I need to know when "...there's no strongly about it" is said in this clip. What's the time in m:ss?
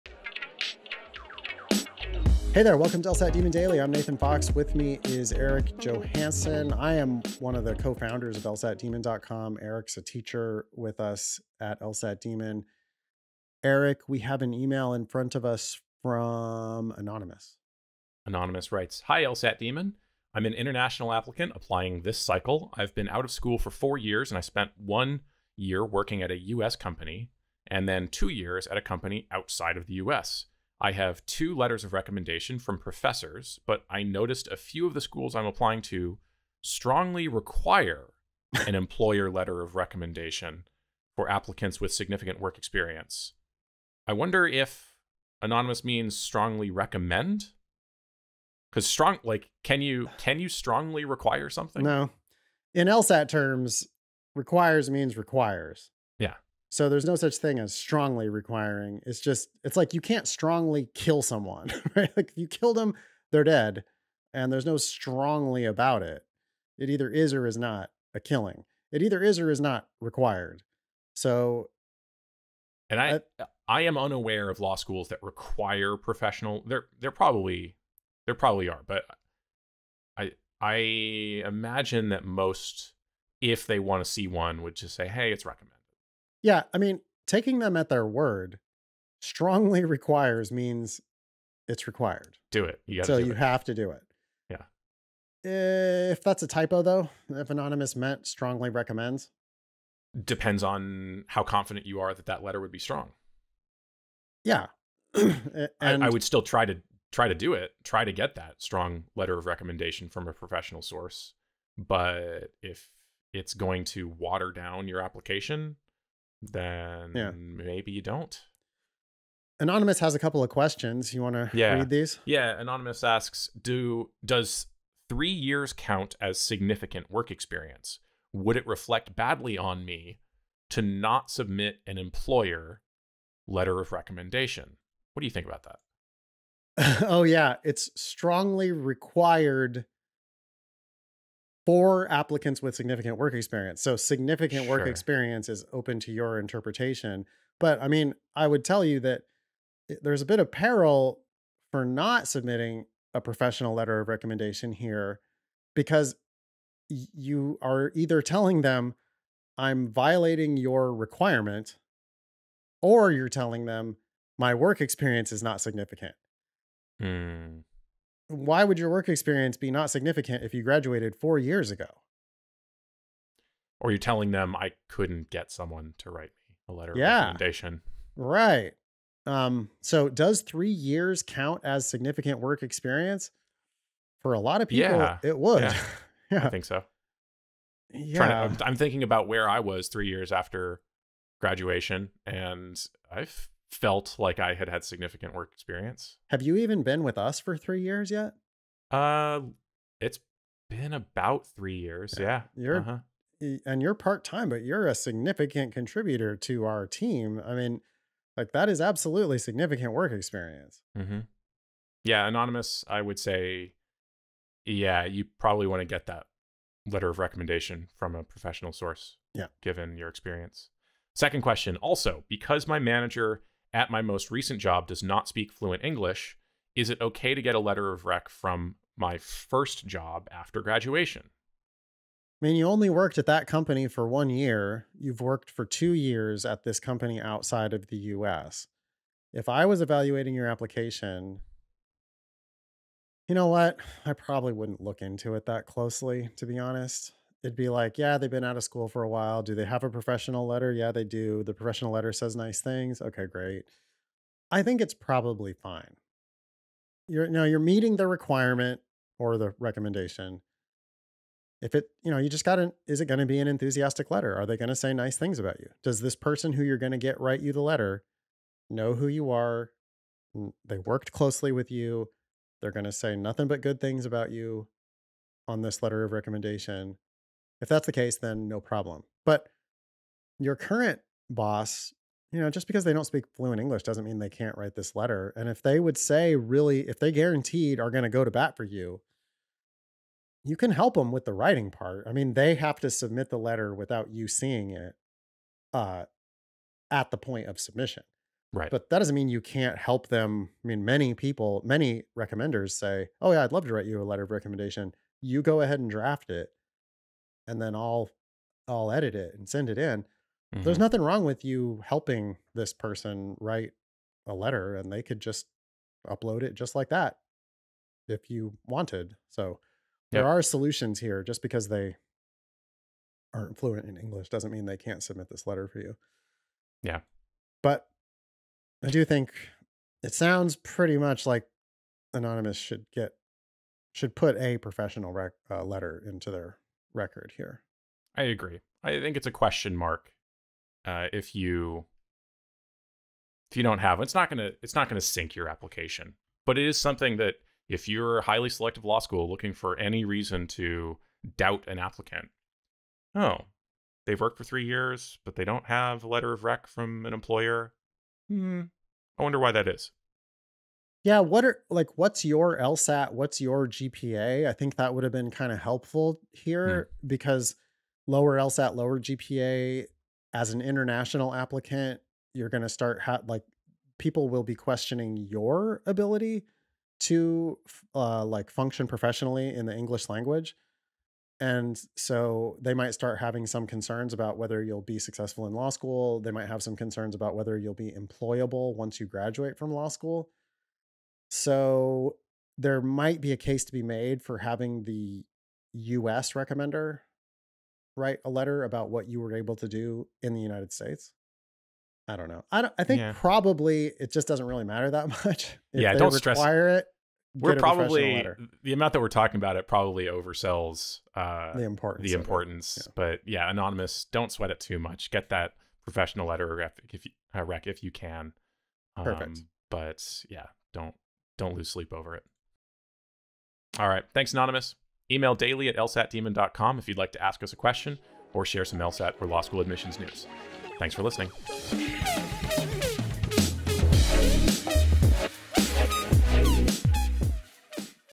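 1:04.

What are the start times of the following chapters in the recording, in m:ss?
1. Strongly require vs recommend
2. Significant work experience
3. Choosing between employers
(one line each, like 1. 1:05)
1. 0:43
2. 1:59
3. 3:41.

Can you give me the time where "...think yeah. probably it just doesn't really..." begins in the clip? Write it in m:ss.
6:42.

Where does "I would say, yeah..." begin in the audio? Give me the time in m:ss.
3:32.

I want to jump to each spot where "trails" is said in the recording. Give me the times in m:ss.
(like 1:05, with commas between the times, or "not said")
not said.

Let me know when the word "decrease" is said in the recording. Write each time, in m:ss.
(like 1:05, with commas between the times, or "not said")
not said.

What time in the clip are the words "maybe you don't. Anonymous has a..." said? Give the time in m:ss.
1:57.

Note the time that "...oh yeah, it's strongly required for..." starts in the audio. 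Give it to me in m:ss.
2:17.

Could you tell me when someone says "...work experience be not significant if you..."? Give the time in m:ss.
2:48.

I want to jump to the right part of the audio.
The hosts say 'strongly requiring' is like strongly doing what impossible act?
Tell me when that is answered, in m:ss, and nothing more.
1:00.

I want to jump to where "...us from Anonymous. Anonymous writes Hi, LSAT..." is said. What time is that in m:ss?
0:15.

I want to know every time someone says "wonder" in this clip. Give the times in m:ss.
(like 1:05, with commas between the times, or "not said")
0:44, 5:59.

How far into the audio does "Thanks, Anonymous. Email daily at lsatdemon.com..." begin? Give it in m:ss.
7:04.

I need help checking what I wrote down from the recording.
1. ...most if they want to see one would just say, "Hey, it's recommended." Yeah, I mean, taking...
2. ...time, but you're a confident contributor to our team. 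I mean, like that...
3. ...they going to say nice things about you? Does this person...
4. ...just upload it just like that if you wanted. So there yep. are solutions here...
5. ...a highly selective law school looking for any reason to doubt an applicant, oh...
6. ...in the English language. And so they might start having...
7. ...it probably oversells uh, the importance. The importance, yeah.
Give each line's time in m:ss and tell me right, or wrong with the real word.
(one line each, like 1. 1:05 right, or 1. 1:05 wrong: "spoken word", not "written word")
1. 1:22 right
2. 3:24 wrong: "significant", not "confident"
3. 4:24 right
4. 5:15 right
5. 5:48 right
6. 6:19 right
7. 6:49 right.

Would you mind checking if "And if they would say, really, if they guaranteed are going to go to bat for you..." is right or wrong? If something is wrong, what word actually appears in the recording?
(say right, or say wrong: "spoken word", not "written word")
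right.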